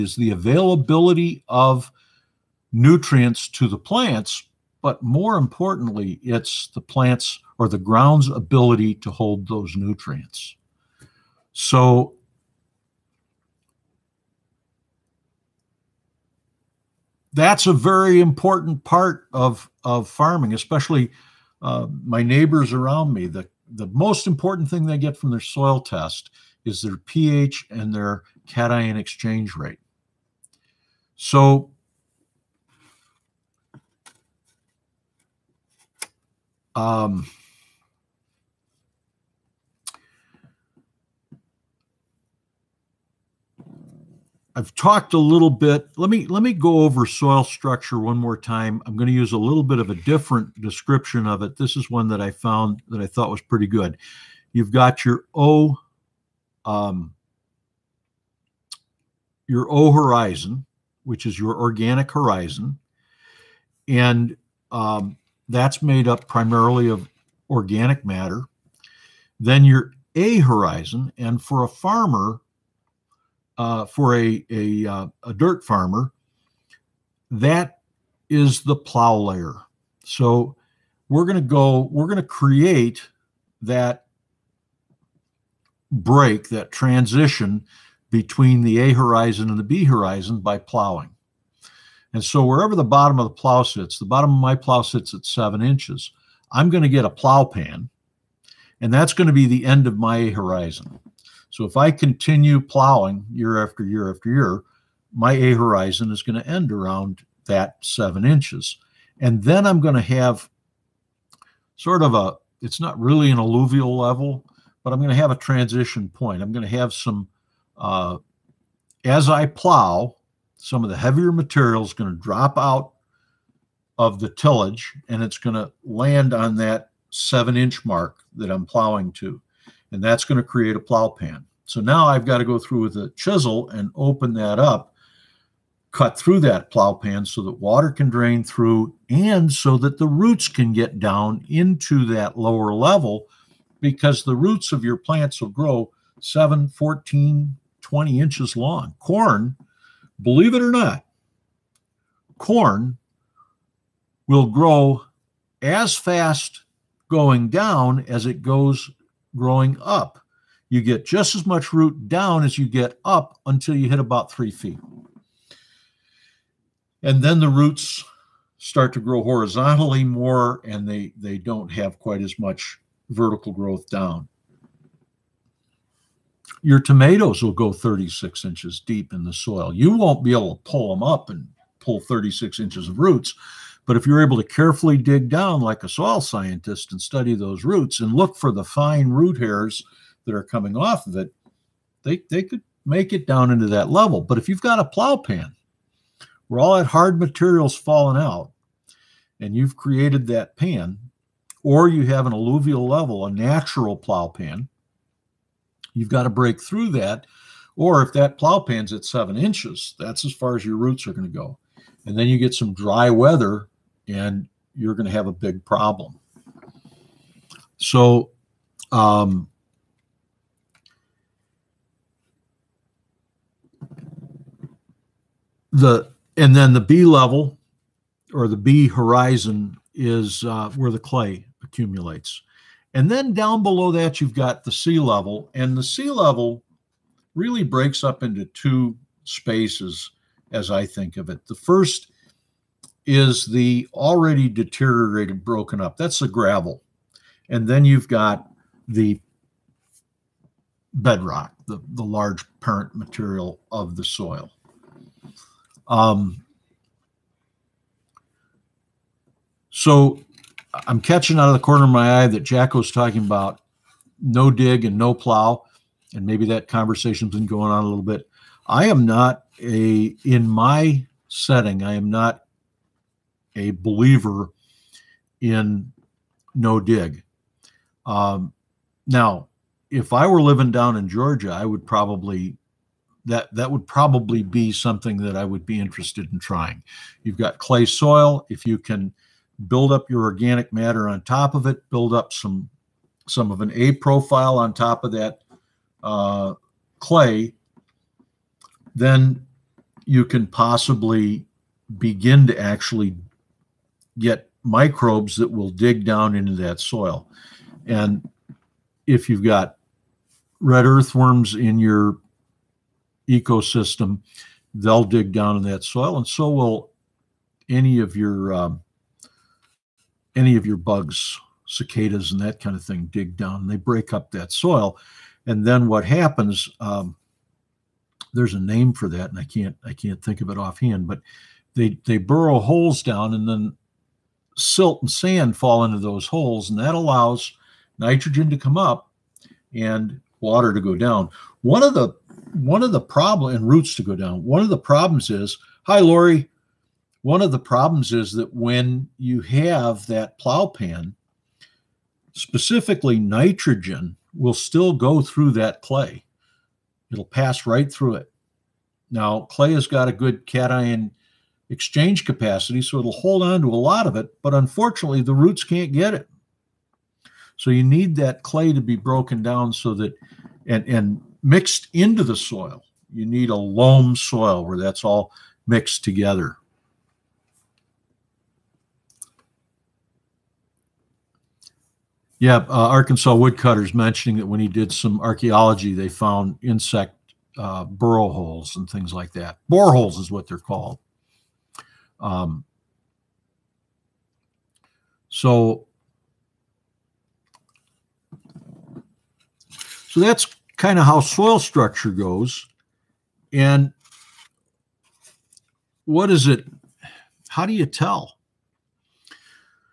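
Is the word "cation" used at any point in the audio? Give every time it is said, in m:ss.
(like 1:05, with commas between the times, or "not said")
0:28, 6:00.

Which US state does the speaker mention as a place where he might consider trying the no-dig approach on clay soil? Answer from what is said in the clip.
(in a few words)
Georgia.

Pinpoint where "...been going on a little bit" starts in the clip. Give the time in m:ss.
4:27.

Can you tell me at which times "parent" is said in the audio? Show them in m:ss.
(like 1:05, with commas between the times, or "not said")
4:12.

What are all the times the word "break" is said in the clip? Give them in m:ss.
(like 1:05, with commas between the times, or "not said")
1:25, 3:26, 3:57, 5:23.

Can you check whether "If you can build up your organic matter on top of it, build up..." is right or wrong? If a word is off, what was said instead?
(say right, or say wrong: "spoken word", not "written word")
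right.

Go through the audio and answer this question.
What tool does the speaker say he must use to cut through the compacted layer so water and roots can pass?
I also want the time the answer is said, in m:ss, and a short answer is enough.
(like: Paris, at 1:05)
A chisel, at 2:13.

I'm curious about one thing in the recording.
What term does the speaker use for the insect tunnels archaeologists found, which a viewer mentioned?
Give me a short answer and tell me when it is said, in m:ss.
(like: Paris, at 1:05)
Boreholes, at 6:29.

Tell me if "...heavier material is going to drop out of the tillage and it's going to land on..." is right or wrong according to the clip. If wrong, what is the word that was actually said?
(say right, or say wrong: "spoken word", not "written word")
right.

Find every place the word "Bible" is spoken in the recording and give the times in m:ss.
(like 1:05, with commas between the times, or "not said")
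not said.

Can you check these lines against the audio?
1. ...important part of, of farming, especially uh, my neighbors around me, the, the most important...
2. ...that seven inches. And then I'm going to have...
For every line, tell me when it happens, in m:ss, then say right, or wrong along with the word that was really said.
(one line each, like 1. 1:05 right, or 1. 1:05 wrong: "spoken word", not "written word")
1. 0:18 right
2. 1:47 right.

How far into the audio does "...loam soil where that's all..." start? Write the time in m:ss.
6:13.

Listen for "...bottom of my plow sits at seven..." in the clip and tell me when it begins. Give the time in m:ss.
1:34.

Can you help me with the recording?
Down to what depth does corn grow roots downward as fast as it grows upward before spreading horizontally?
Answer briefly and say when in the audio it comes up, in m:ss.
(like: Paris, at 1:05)
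About three feet, at 2:43.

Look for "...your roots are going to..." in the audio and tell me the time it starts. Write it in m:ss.
3:30.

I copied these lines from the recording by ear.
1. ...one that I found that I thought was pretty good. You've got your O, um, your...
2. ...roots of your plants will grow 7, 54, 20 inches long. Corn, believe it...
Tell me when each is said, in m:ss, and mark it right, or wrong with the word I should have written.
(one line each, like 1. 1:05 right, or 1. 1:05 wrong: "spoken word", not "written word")
1. 0:51 right
2. 2:24 wrong: "14", not "54".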